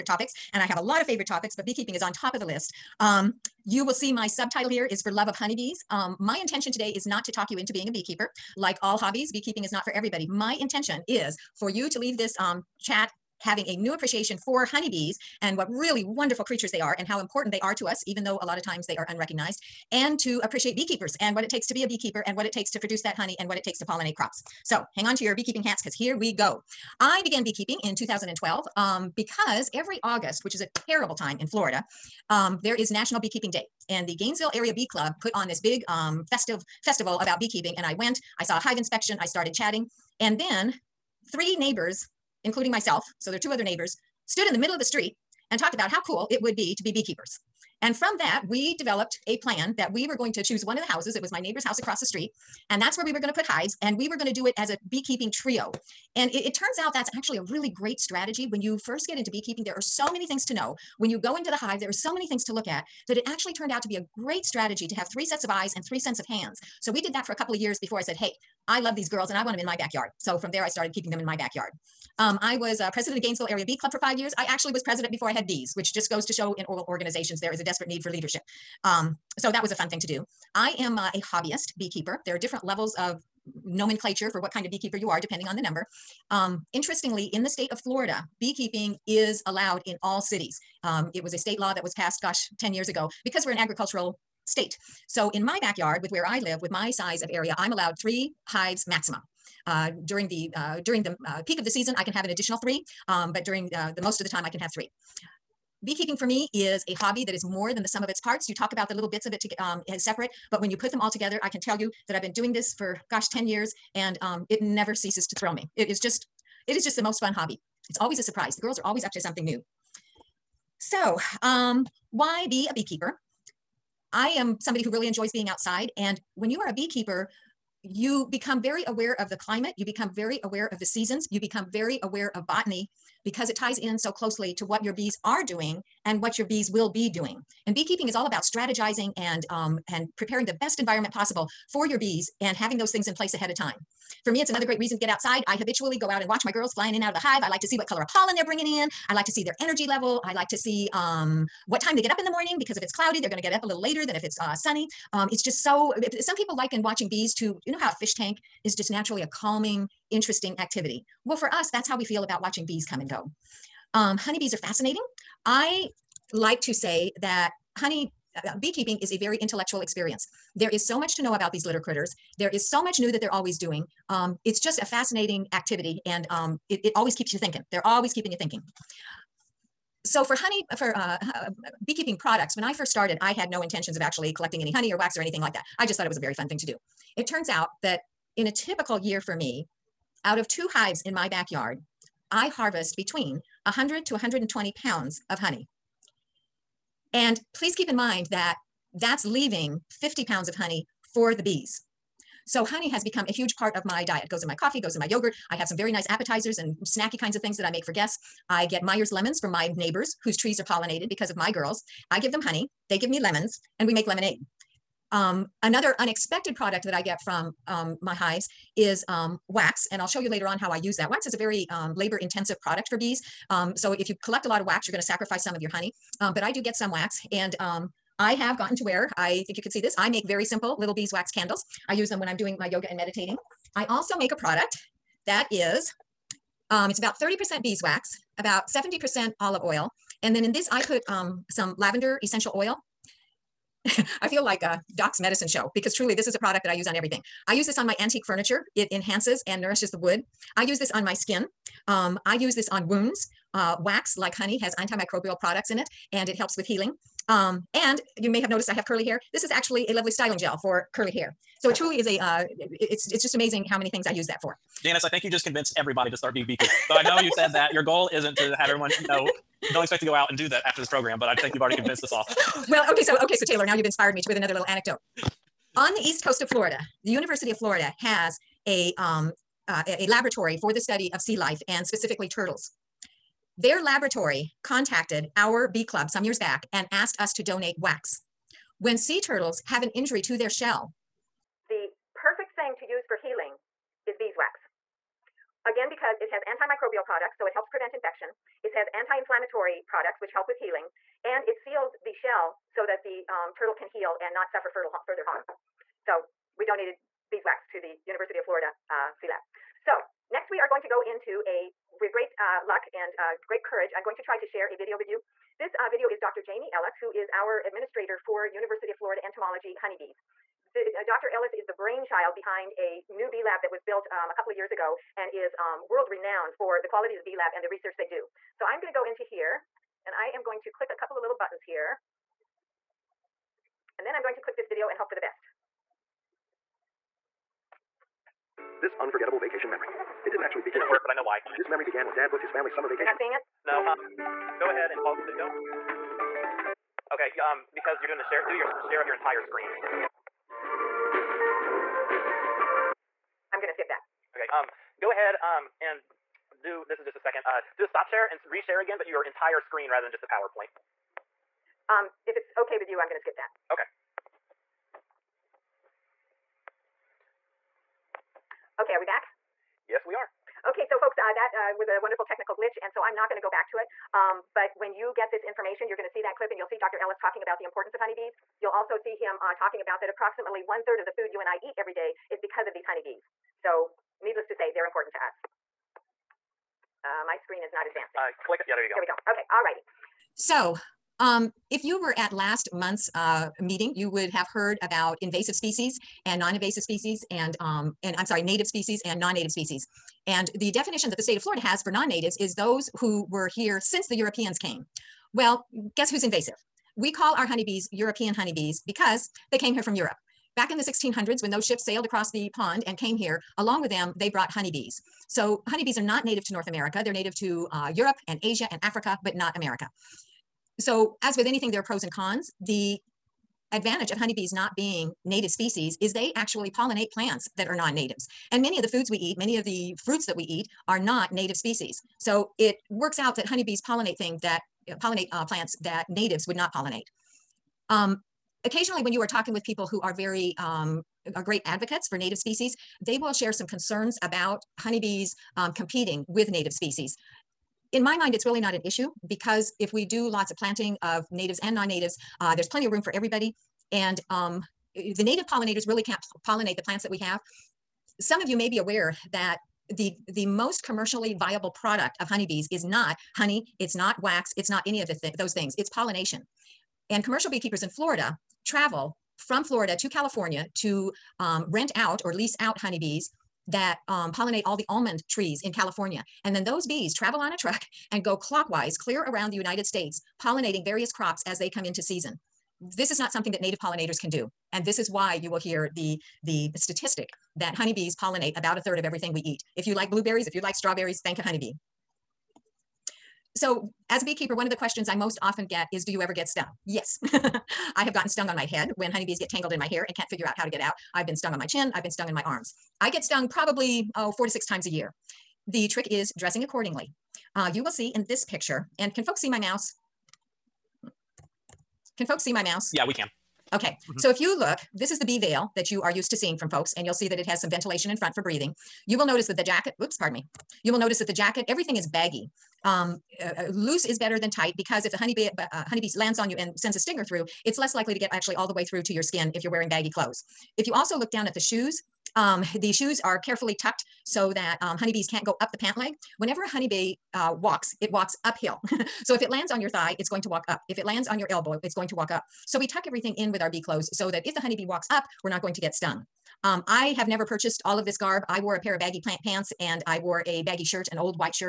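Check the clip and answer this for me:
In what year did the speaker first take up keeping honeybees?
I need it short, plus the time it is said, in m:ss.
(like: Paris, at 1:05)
2012, at 0:27.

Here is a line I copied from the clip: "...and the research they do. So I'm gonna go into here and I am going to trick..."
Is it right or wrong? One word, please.
wrong.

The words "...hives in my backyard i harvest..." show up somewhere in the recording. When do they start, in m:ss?
3:10.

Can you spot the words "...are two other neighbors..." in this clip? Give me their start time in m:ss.
0:43.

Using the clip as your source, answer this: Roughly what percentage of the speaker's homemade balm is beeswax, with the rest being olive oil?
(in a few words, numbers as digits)
30%.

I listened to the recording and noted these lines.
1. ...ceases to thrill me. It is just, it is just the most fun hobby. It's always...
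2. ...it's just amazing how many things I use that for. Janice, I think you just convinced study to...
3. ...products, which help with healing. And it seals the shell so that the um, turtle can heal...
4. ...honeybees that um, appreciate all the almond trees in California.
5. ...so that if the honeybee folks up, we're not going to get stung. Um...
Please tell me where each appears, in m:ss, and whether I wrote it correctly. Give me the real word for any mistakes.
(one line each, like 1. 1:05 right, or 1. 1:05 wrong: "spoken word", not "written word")
1. 1:54 right
2. 4:23 wrong: "everybody", not "study"
3. 4:59 right
4. 7:52 wrong: "pollinate", not "appreciate"
5. 9:04 wrong: "walks", not "folks".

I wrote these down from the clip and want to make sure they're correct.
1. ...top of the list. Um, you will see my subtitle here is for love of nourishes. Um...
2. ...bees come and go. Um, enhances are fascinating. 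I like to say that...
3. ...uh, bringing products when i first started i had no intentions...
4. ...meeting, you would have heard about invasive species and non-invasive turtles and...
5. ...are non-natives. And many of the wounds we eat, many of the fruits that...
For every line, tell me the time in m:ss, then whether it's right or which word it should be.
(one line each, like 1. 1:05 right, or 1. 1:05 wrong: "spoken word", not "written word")
1. 0:02 wrong: "honeybees", not "nourishes"
2. 2:42 wrong: "honeybees", not "enhances"
3. 3:01 wrong: "beekeeping", not "bringing"
4. 6:33 wrong: "species", not "turtles"
5. 7:07 wrong: "foods", not "wounds".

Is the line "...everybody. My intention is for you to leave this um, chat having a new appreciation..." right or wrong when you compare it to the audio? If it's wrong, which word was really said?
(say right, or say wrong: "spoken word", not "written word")
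right.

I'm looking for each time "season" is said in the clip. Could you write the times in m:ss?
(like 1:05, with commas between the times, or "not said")
1:41, 2:10, 8:02.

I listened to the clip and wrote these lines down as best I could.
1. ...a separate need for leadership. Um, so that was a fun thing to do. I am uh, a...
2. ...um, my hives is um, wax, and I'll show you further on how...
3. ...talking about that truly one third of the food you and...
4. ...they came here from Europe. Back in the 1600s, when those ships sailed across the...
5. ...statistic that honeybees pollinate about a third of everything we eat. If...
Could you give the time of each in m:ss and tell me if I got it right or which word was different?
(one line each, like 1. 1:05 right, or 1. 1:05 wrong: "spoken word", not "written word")
1. 1:17 wrong: "desperate", not "separate"
2. 3:37 wrong: "later", not "further"
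3. 6:19 wrong: "approximately", not "truly"
4. 6:49 right
5. 8:06 right.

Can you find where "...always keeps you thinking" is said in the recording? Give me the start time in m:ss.
2:56.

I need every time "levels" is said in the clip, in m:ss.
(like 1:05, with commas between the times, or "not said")
1:22, 2:29.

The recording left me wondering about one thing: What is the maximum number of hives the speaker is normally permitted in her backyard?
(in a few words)
3.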